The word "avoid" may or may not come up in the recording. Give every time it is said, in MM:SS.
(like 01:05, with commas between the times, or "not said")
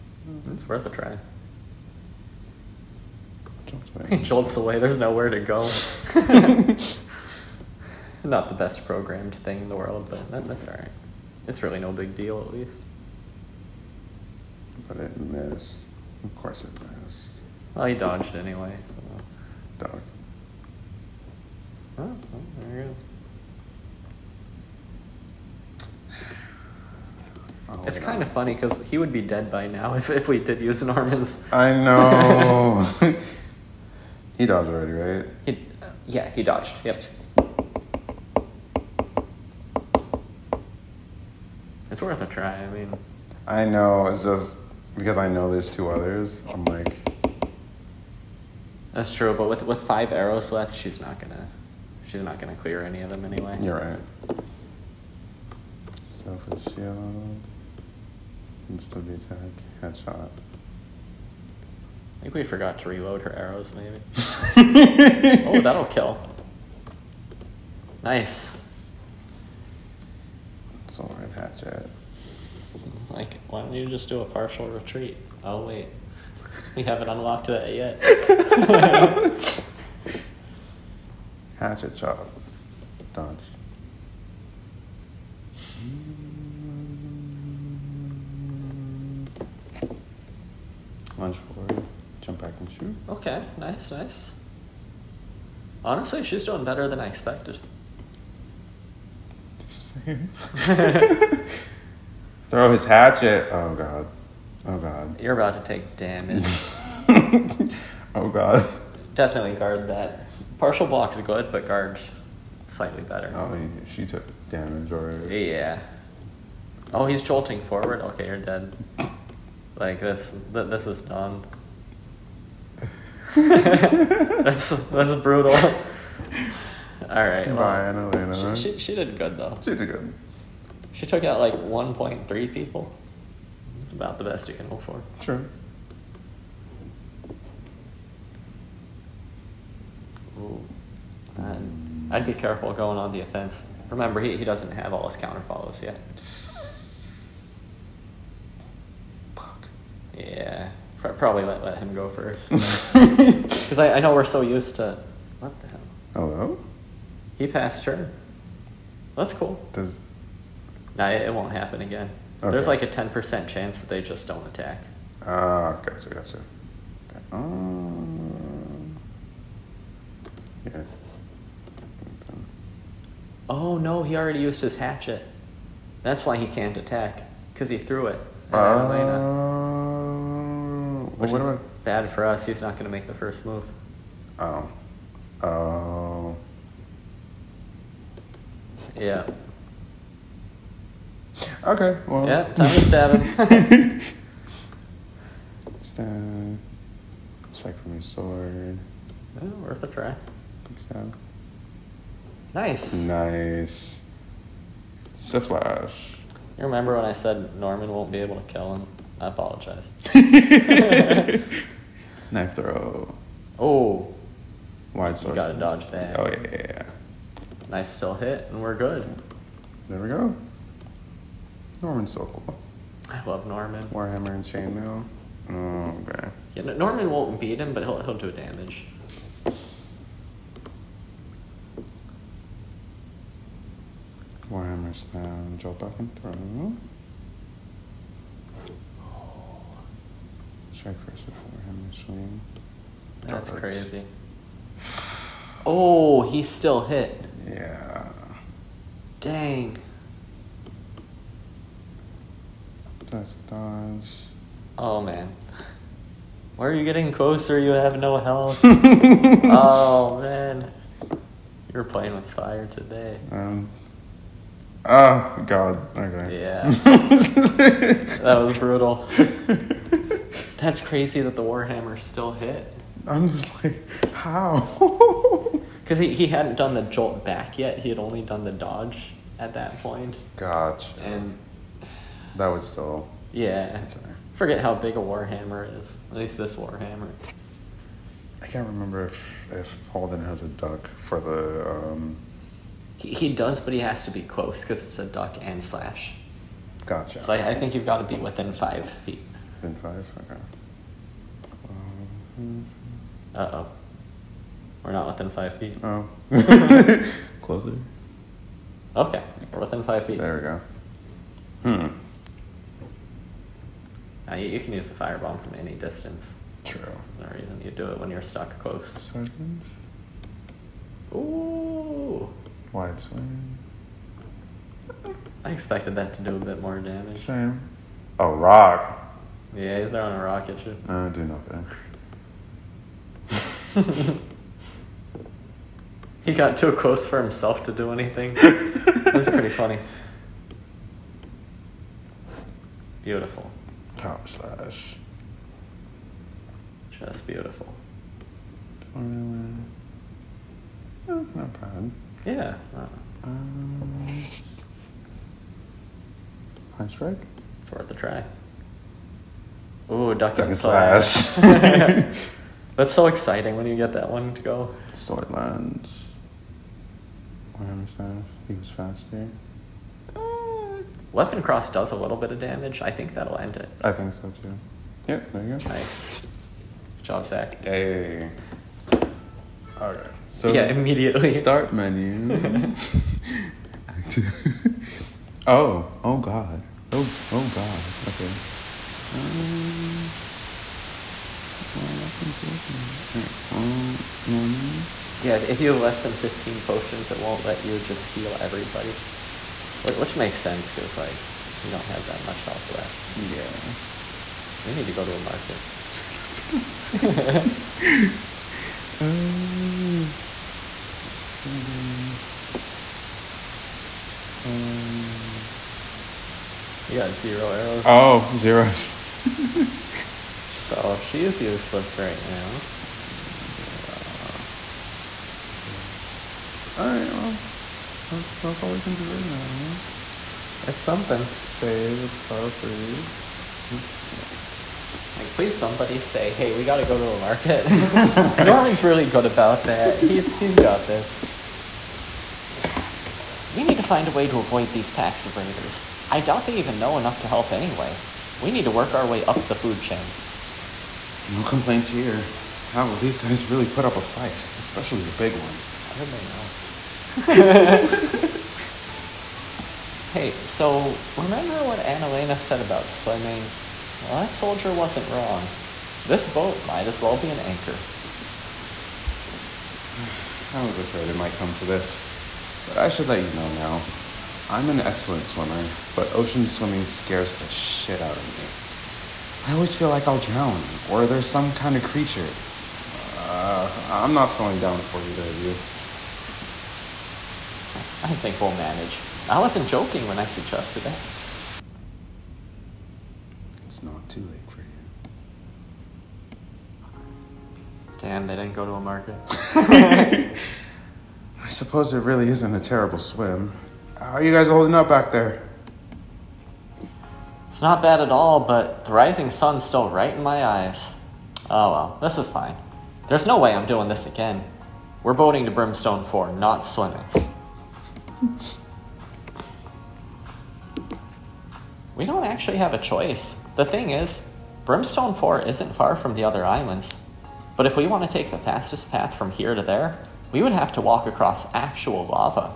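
07:24.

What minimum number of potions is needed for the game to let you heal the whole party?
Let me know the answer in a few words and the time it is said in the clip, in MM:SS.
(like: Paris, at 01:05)
15, at 06:36.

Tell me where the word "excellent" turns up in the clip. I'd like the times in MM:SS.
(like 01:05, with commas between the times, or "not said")
07:54.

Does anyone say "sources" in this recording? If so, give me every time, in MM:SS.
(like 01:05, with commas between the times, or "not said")
not said.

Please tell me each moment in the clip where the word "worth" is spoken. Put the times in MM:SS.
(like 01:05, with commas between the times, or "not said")
00:00, 00:42, 03:19, 05:57.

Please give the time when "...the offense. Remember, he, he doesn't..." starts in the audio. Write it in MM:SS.
02:23.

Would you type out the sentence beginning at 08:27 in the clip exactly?
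It's not bad at all, but the rising sun's still right in my eyes.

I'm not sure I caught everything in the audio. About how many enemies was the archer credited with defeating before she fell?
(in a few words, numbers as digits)
1.3.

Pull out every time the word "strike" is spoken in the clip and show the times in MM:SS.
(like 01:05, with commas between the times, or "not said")
03:17, 04:00, 05:56.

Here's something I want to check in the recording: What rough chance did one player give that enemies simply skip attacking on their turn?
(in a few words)
10%.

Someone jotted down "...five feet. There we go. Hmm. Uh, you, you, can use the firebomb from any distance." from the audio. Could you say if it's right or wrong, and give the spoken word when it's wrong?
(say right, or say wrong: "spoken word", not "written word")
right.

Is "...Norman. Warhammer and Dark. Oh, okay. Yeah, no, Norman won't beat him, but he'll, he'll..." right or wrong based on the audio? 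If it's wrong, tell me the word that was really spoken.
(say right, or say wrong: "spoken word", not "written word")
wrong: "Chainmail", not "Dark".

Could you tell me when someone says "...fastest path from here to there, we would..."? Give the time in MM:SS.
08:48.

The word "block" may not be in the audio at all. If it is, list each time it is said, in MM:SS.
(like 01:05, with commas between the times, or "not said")
01:50.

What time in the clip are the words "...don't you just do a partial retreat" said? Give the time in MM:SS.
01:13.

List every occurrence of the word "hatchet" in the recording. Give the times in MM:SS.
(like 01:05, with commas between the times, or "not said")
01:11, 01:21, 01:42, 02:54.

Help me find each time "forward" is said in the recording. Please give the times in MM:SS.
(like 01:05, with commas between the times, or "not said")
01:31, 01:57.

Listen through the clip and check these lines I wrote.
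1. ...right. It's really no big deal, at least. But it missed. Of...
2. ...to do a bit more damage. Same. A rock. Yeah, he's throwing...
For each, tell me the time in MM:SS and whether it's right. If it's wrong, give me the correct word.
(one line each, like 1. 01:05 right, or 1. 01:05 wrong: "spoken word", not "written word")
1. 00:10 right
2. 05:26 right.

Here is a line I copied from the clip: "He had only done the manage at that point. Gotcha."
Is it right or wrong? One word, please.
wrong.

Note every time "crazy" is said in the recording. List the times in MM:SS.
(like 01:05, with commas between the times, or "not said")
04:03, 04:30.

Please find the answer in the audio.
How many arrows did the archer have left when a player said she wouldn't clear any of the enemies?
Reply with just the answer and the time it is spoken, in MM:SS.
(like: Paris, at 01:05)
5, at 00:49.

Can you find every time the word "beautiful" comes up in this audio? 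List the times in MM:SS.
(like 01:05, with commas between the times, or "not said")
05:43, 05:47.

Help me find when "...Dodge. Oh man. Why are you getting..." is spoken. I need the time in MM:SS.
04:13.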